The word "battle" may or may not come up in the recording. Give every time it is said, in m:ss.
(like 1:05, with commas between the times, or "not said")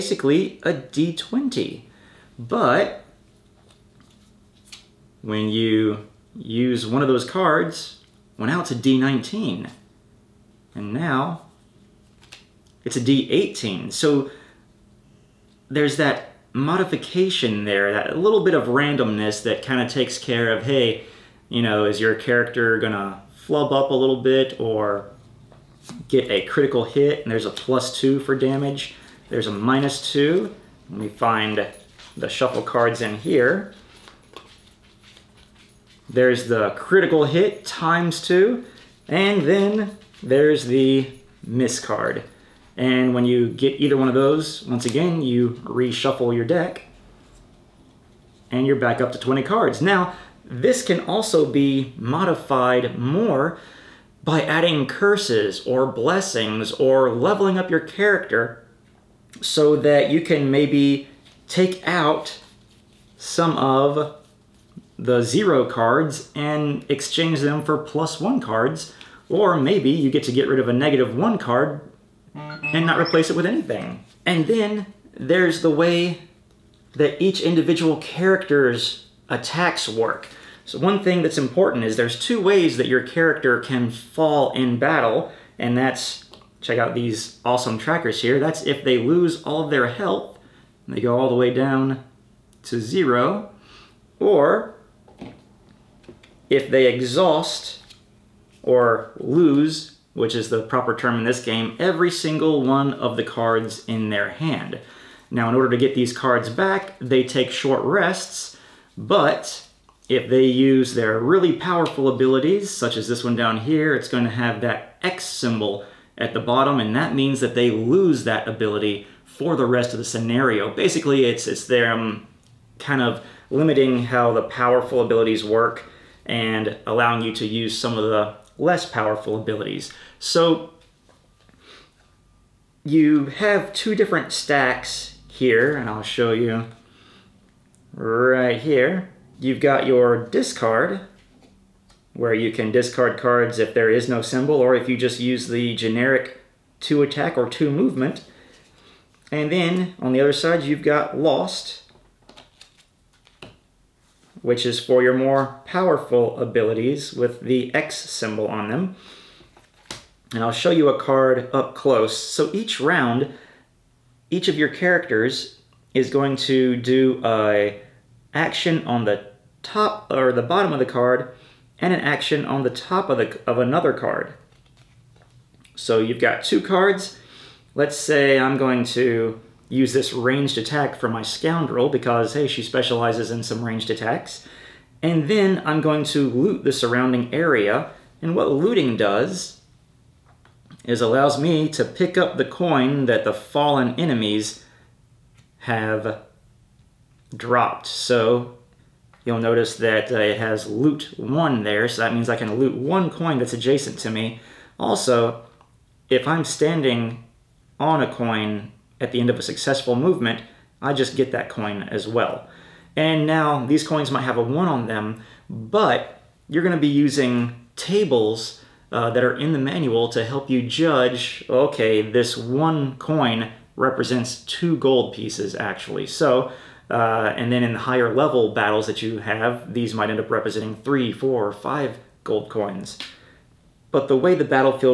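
1:24, 3:48.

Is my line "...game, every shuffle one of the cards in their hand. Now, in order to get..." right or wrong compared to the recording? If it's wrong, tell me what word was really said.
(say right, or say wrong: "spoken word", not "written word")
wrong: "single", not "shuffle".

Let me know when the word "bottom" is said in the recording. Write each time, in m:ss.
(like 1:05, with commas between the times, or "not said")
1:56, 2:50.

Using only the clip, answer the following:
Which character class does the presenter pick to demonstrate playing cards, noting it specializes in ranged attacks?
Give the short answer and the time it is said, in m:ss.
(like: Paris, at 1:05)
scoundrel, at 3:01.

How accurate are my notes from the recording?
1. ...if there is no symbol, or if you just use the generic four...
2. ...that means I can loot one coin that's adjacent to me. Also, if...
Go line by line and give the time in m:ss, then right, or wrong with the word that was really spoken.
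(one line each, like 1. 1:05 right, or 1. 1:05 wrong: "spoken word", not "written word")
1. 2:23 wrong: "two", not "four"
2. 3:22 right.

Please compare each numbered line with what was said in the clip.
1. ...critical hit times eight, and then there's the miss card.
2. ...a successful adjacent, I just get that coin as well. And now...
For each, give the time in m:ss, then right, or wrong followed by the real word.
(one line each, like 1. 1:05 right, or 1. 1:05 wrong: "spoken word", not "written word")
1. 0:36 wrong: "two", not "eight"
2. 3:29 wrong: "movement", not "adjacent".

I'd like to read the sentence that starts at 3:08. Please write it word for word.
And what looting does is allows me to pick up the coin that the fallen enemies have dropped.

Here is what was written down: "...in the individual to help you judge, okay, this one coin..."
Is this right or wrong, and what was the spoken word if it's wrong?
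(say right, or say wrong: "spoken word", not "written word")
wrong: "manual", not "individual".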